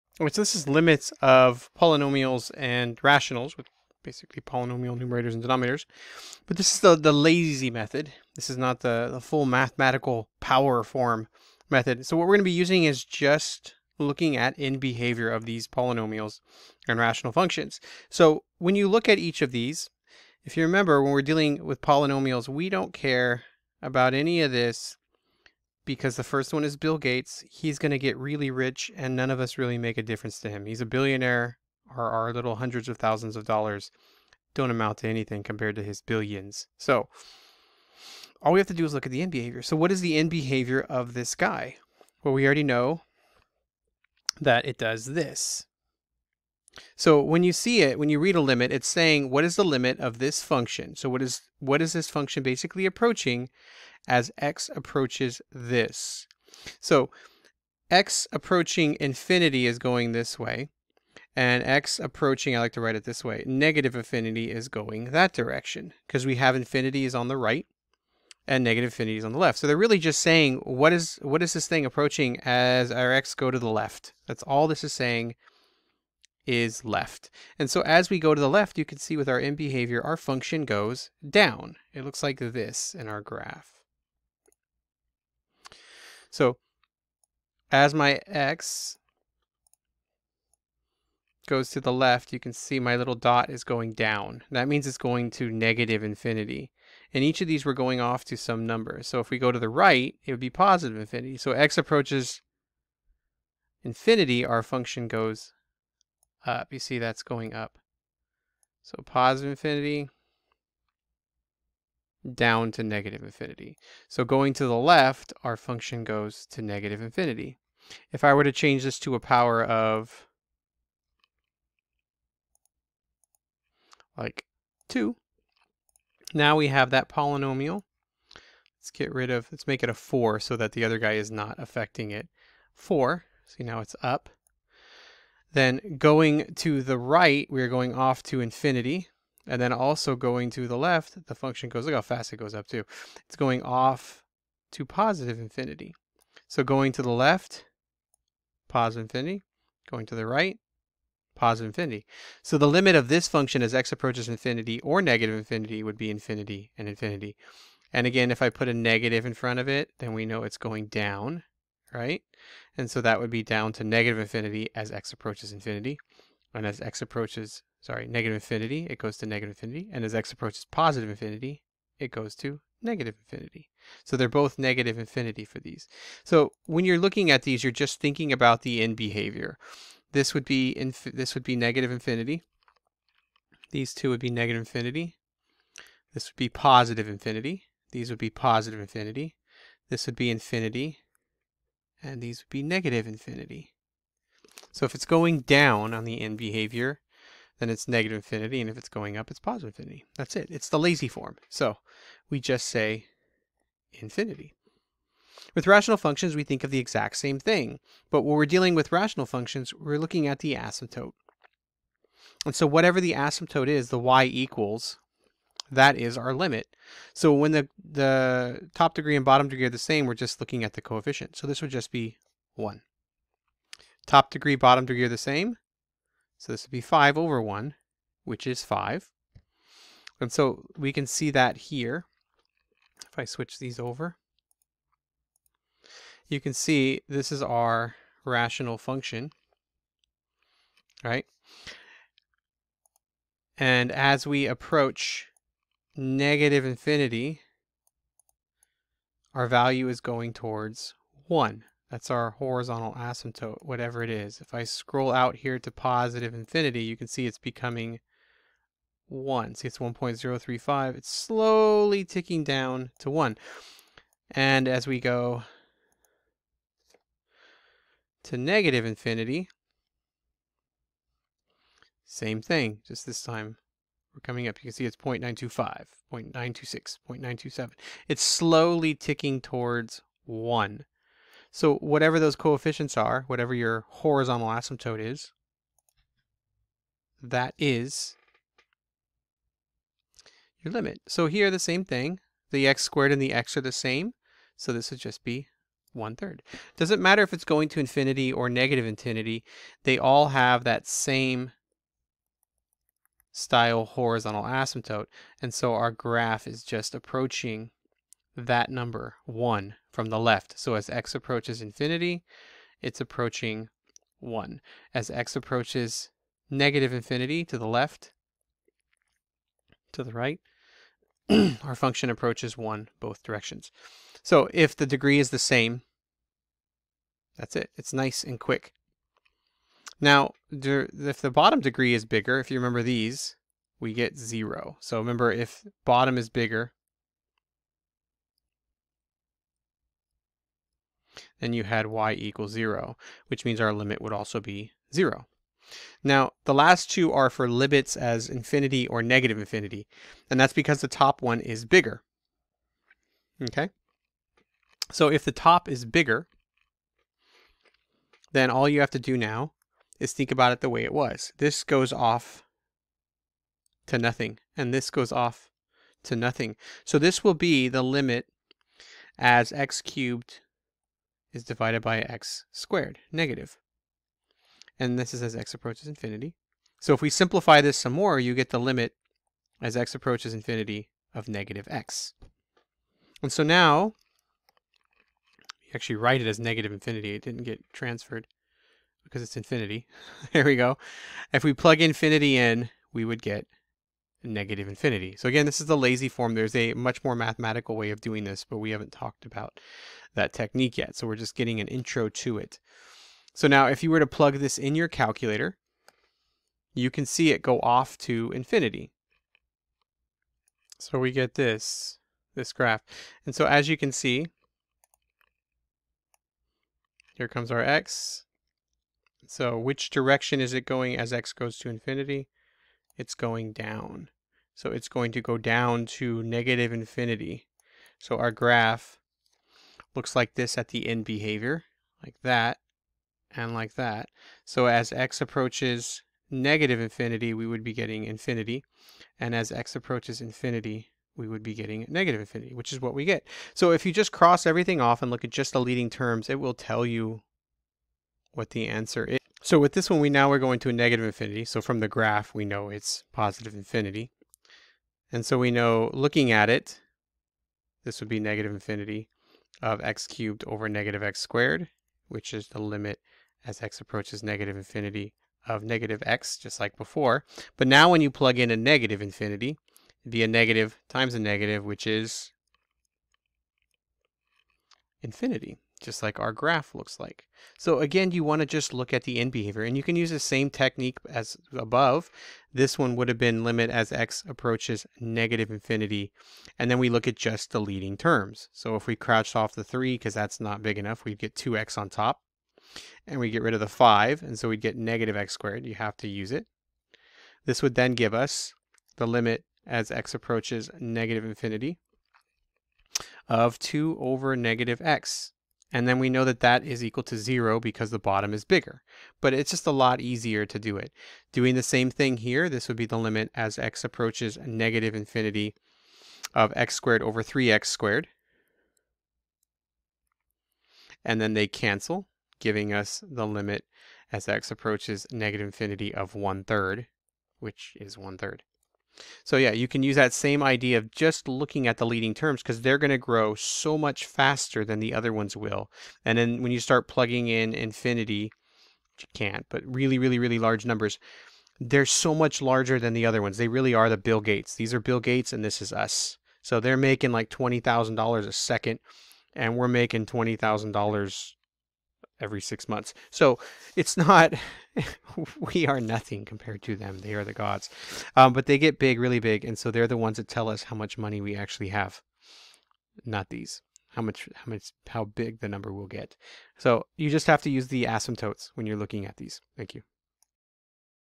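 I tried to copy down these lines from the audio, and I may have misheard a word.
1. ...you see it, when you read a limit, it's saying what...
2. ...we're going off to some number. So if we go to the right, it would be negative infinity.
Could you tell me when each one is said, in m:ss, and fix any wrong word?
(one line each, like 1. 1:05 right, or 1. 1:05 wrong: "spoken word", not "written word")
1. 0:47 right
2. 1:37 wrong: "positive", not "negative".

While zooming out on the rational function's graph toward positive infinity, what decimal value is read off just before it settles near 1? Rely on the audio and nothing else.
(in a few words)
1.035.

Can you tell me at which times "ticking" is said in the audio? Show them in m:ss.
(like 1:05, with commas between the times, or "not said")
4:22, 4:38.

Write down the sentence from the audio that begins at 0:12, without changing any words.
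So what we're going to be using is just looking at in behavior of these polynomials and rational functions.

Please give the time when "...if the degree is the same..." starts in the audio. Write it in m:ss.
5:24.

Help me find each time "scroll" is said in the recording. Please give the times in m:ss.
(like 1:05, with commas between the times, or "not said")
4:14.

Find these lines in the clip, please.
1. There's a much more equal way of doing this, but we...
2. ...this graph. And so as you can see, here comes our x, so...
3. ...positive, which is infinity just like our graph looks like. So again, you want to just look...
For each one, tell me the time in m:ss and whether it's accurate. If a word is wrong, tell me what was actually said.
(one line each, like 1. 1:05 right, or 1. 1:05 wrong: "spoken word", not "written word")
1. 6:36 wrong: "mathematical", not "equal"
2. 6:52 right
3. 7:51 wrong: "negative", not "positive".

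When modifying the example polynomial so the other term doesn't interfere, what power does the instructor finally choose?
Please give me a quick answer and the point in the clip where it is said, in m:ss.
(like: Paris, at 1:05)
4, at 2:09.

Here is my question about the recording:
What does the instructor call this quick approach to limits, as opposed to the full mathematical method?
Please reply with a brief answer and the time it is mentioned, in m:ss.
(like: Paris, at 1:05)
the lazy method, at 0:06.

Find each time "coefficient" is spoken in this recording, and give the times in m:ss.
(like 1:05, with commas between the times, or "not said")
3:40, 4:42.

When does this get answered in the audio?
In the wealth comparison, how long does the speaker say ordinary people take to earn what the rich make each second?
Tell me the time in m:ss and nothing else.
9:12.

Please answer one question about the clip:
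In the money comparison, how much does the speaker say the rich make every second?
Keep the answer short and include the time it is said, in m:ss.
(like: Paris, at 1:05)
$20,000, at 9:07.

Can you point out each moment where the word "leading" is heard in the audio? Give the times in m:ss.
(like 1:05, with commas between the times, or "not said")
7:25, 8:07, 8:51.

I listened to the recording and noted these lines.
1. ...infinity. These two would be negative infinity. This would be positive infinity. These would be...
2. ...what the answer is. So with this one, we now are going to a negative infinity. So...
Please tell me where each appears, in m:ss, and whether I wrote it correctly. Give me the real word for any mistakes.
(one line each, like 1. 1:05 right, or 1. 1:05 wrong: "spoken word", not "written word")
1. 3:01 right
2. 7:28 right.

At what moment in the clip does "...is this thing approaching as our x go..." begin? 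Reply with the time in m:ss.
1:11.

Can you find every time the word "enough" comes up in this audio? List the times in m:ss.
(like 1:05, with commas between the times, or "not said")
8:10.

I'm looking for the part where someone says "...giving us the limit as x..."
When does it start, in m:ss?
8:42.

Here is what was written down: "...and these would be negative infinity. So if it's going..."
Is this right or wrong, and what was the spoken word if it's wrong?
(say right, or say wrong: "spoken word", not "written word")
right.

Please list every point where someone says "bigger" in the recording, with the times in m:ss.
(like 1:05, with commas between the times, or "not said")
5:32, 5:36, 5:51, 5:55, 8:28.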